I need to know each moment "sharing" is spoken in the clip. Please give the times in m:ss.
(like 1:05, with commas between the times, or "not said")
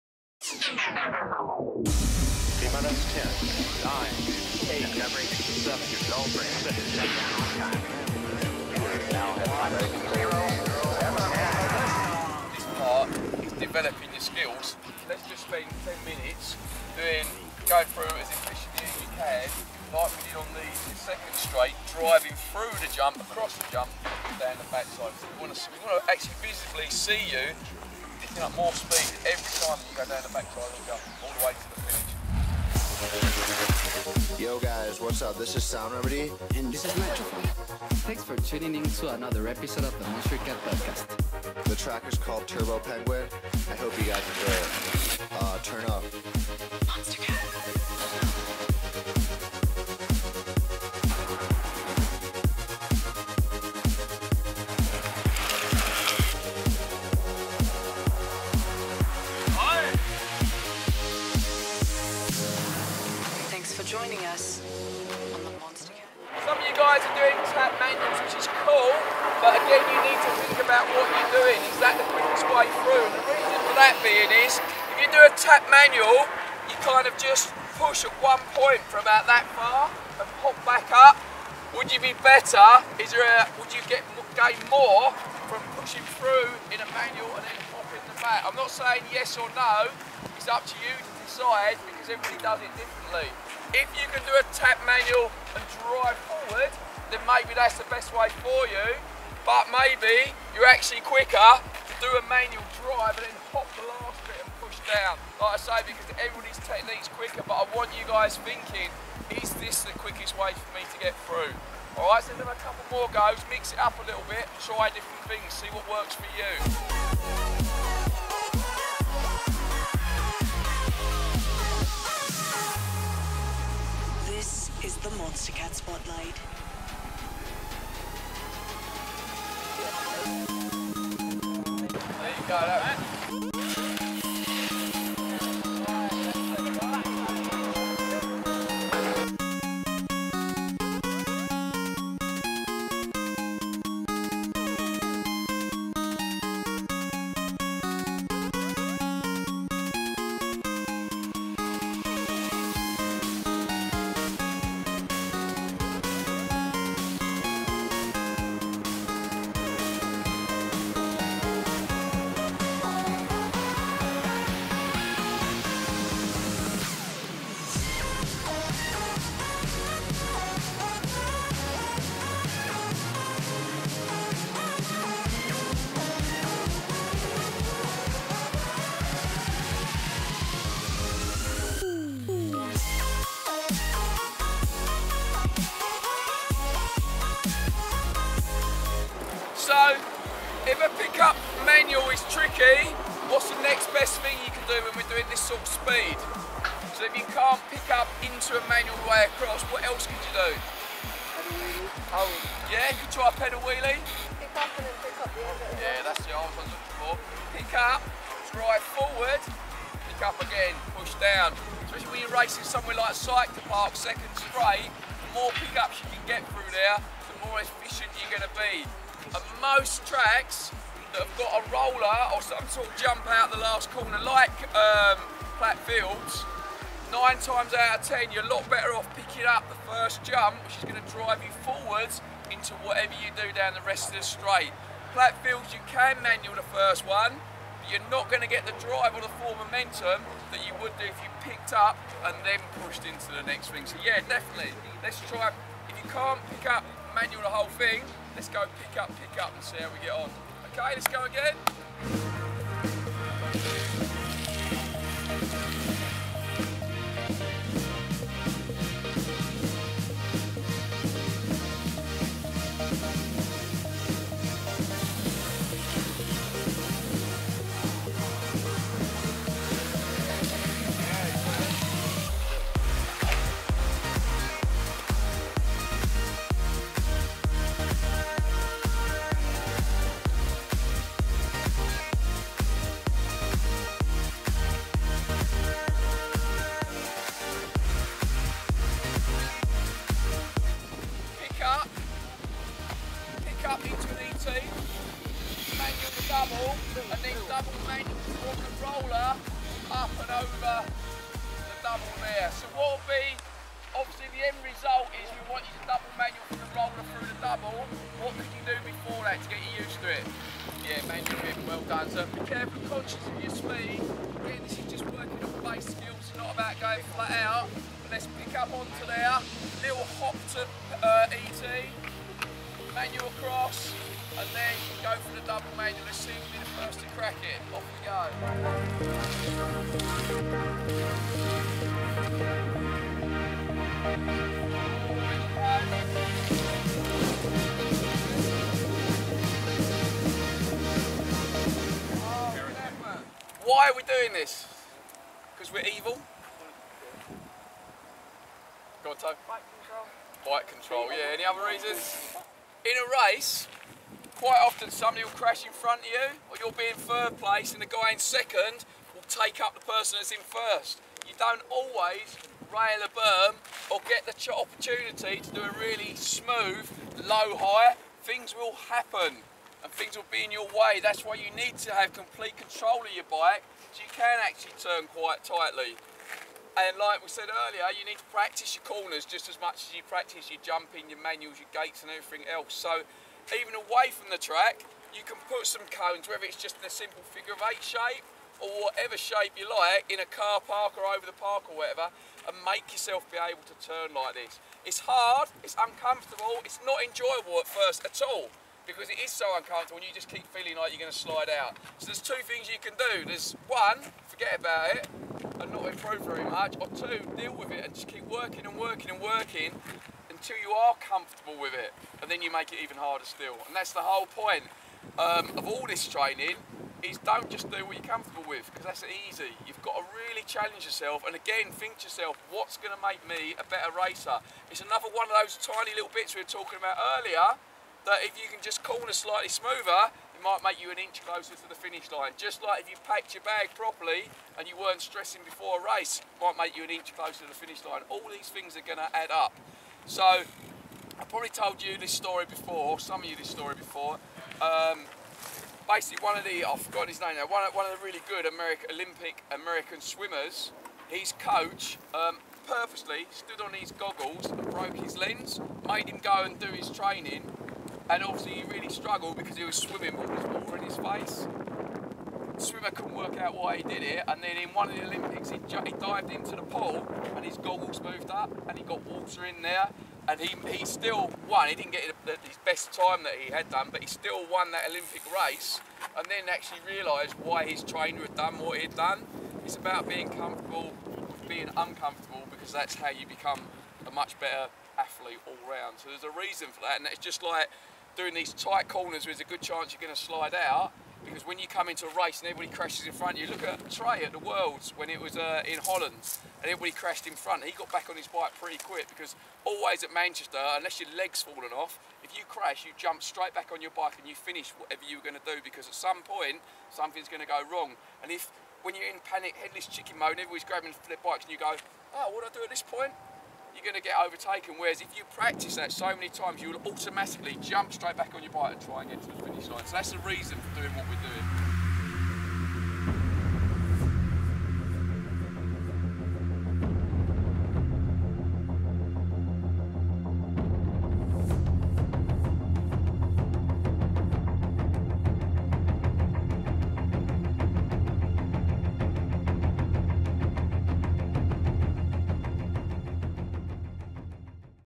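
not said.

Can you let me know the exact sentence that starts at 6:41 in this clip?
So there's two things you can do.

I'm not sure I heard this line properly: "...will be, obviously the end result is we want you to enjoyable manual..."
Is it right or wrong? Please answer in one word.
wrong.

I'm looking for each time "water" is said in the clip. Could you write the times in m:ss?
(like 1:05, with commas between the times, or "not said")
7:40, 7:49.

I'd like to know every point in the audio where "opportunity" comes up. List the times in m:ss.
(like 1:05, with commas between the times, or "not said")
6:04.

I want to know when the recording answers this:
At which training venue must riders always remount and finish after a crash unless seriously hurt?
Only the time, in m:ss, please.
8:20.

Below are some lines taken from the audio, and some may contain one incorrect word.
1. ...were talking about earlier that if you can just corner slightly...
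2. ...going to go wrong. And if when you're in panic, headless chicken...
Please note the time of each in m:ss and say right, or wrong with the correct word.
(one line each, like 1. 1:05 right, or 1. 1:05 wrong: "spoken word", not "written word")
1. 7:06 right
2. 8:27 right.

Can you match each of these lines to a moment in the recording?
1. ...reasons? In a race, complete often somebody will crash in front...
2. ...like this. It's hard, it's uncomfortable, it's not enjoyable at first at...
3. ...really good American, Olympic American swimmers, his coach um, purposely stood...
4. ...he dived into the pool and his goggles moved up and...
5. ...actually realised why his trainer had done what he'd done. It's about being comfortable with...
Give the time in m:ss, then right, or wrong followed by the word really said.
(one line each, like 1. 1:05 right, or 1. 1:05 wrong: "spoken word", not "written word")
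1. 5:51 wrong: "quite", not "complete"
2. 6:34 right
3. 7:28 right
4. 7:45 right
5. 7:56 right.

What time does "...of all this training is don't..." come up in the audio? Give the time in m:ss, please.
6:55.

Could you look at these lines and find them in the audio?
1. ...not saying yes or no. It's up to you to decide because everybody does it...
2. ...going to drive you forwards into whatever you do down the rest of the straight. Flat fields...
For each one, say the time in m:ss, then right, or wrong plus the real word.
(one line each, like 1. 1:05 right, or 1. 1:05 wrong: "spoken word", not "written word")
1. 1:28 right
2. 3:50 right.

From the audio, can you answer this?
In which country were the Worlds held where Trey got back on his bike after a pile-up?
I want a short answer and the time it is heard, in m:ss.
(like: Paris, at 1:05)
Holland, at 8:15.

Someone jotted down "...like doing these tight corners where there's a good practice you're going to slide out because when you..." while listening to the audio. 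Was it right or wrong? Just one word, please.
wrong.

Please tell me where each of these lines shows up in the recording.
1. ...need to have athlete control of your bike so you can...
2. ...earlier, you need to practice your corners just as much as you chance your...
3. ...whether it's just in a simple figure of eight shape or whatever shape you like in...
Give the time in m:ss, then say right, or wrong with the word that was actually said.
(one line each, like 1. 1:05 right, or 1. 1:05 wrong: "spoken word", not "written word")
1. 6:11 wrong: "complete", not "athlete"
2. 6:17 wrong: "practice", not "chance"
3. 6:26 right.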